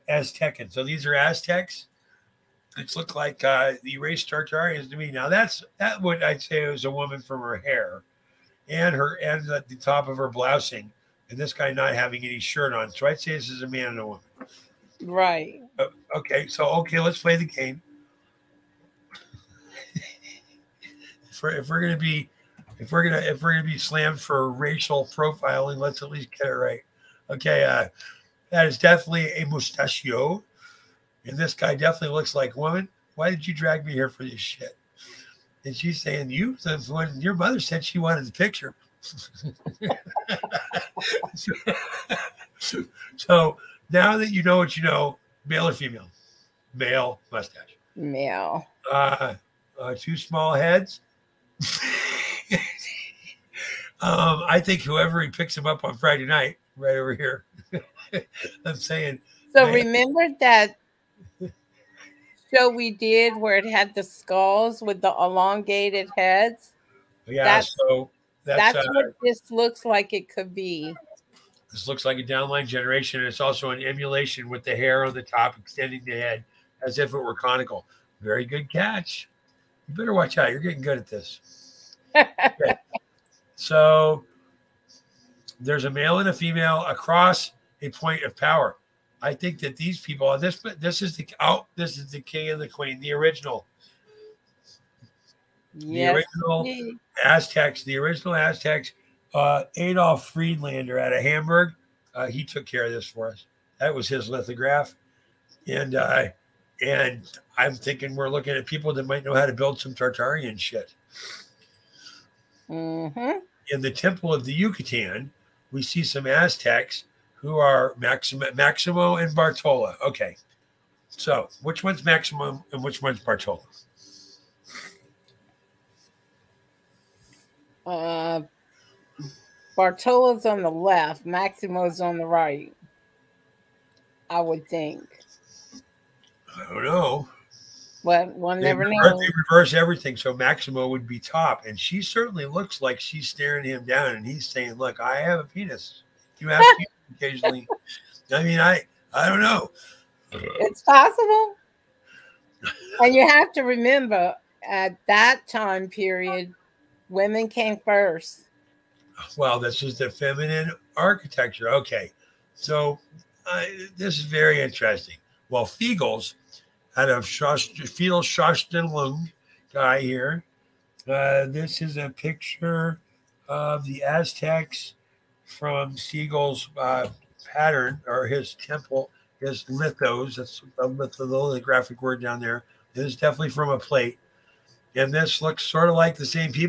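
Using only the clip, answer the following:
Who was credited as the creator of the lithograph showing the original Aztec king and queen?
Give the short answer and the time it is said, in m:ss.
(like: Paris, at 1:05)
Adolf Friedlander, at 1:39.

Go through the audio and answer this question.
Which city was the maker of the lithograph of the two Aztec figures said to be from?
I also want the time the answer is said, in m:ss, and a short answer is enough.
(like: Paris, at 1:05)
Hamburg, at 1:41.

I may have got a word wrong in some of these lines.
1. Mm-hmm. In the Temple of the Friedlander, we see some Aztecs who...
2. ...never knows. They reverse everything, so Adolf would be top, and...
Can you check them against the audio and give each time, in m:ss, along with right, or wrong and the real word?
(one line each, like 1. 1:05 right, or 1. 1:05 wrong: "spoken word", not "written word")
1. 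1:52 wrong: "Yucatan", not "Friedlander"
2. 2:18 wrong: "Maximo", not "Adolf".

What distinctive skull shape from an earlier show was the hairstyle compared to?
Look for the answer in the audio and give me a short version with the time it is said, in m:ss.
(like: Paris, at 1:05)
elongated heads, at 1:05.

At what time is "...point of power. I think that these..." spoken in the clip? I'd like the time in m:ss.
1:27.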